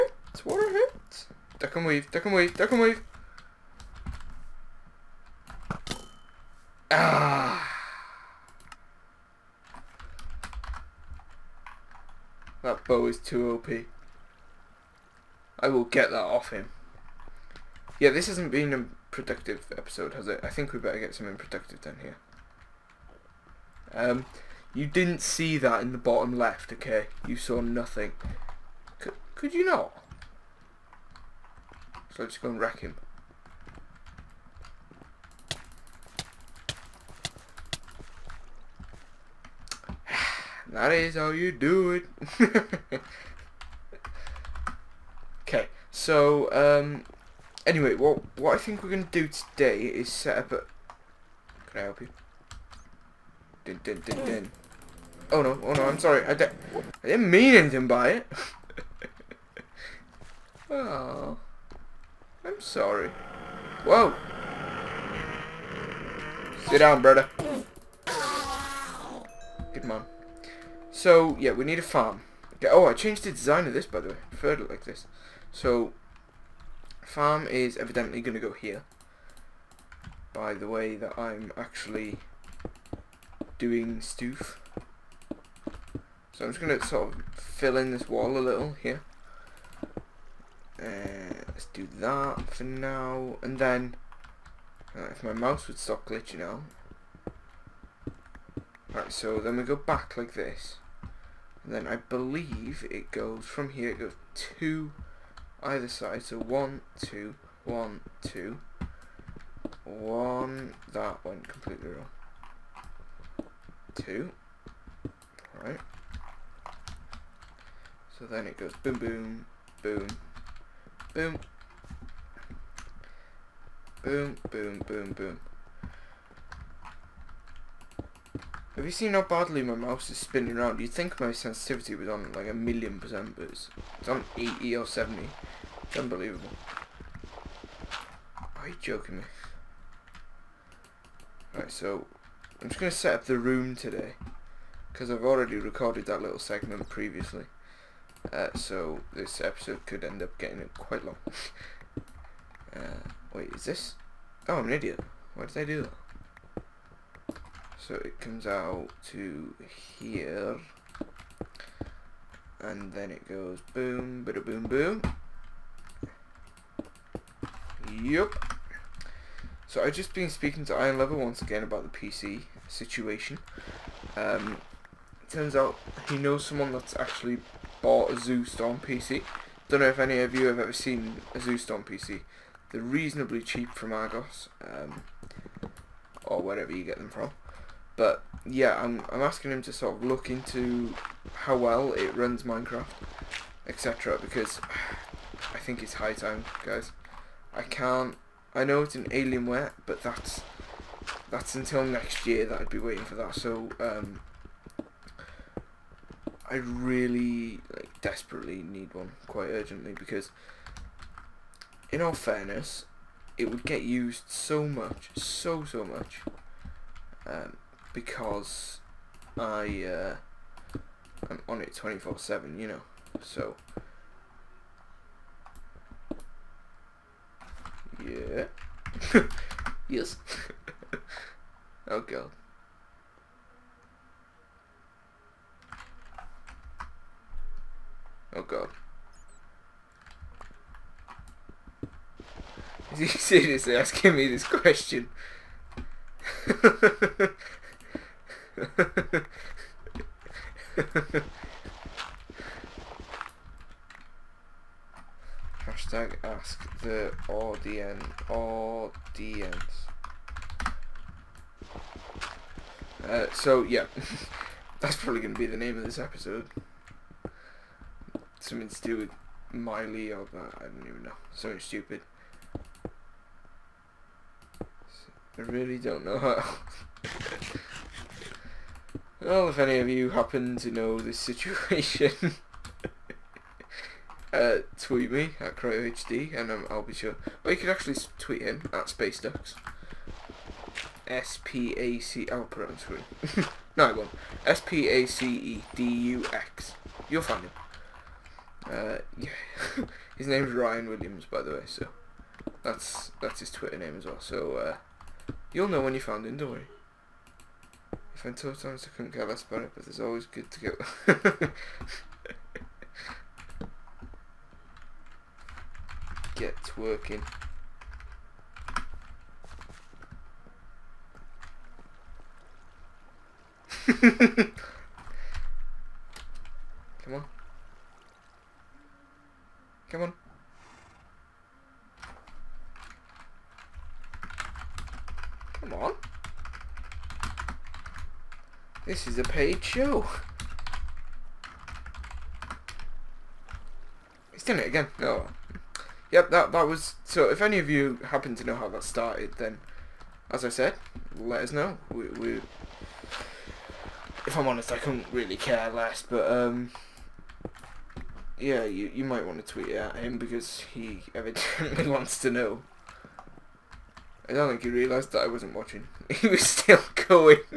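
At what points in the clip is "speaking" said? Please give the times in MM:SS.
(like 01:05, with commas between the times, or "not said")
02:50.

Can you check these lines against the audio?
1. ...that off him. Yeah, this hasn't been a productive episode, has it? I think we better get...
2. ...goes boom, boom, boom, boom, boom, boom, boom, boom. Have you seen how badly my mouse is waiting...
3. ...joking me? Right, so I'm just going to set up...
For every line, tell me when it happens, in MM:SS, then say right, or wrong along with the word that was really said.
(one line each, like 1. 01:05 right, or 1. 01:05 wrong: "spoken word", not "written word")
1. 00:16 right
2. 01:58 wrong: "spinning", not "waiting"
3. 02:18 right.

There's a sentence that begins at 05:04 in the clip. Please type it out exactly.
So uh, you'll know when you found him, don't worry.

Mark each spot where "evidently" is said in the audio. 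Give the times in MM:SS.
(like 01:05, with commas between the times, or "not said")
01:17, 06:01.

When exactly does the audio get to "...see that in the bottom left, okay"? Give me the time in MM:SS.
00:25.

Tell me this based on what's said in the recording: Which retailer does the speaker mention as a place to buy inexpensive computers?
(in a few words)
Argos.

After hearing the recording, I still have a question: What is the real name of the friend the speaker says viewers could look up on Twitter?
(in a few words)
Ryan Williams.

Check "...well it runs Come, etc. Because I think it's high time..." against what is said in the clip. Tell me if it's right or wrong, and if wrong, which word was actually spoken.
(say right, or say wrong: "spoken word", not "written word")
wrong: "Minecraft", not "Come".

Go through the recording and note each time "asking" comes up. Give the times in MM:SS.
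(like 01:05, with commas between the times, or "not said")
03:09, 04:03.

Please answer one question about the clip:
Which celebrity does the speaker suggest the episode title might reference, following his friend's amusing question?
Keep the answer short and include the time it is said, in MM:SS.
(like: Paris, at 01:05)
Miley, at 04:29.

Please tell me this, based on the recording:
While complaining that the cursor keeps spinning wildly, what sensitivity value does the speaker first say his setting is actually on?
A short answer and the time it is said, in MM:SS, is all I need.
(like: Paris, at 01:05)
80, at 02:14.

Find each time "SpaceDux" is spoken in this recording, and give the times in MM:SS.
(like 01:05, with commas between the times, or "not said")
04:48.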